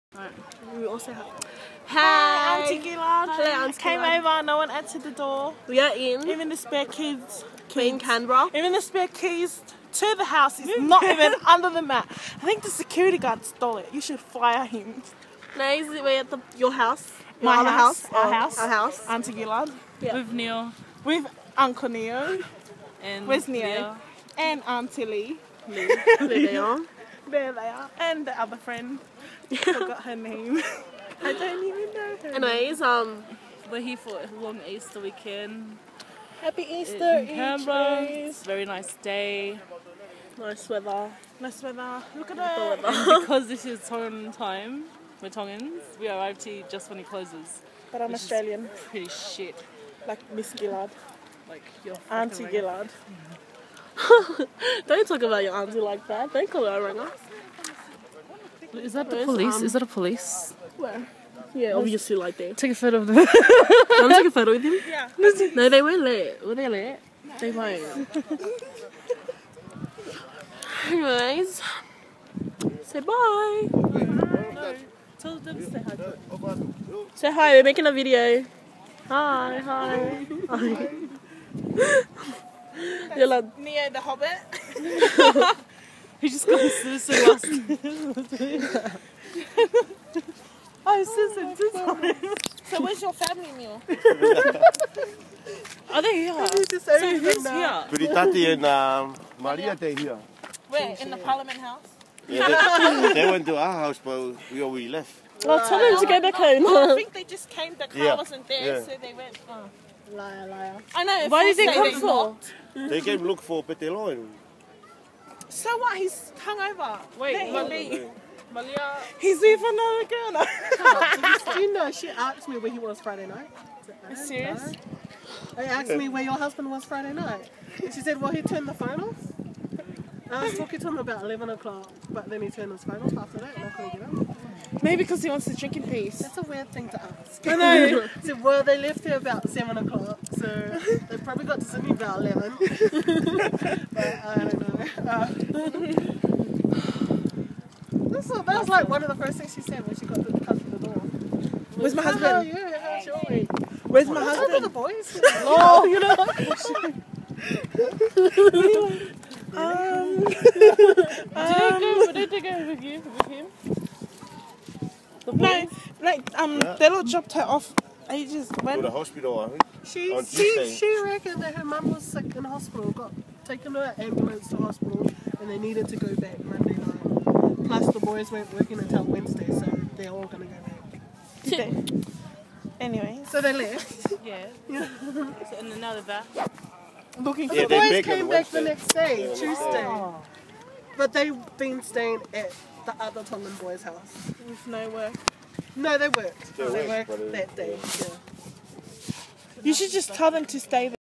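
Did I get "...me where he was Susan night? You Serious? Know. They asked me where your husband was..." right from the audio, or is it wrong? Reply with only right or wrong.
wrong.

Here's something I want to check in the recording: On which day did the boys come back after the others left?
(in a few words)
Tuesday.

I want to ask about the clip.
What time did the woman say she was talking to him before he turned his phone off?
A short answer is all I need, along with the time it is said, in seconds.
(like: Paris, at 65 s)
11 o'clock, at 130 s.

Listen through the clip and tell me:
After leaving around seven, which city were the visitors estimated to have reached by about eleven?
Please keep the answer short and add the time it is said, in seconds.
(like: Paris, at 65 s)
Sydney, at 141 s.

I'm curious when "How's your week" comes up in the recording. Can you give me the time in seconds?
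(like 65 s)
152 s.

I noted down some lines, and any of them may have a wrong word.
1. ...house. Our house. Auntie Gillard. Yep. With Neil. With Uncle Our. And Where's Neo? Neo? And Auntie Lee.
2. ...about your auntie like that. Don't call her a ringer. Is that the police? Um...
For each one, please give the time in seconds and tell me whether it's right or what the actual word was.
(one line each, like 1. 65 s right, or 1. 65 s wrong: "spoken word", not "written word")
1. 18 s wrong: "Neo", not "Our"
2. 55 s right.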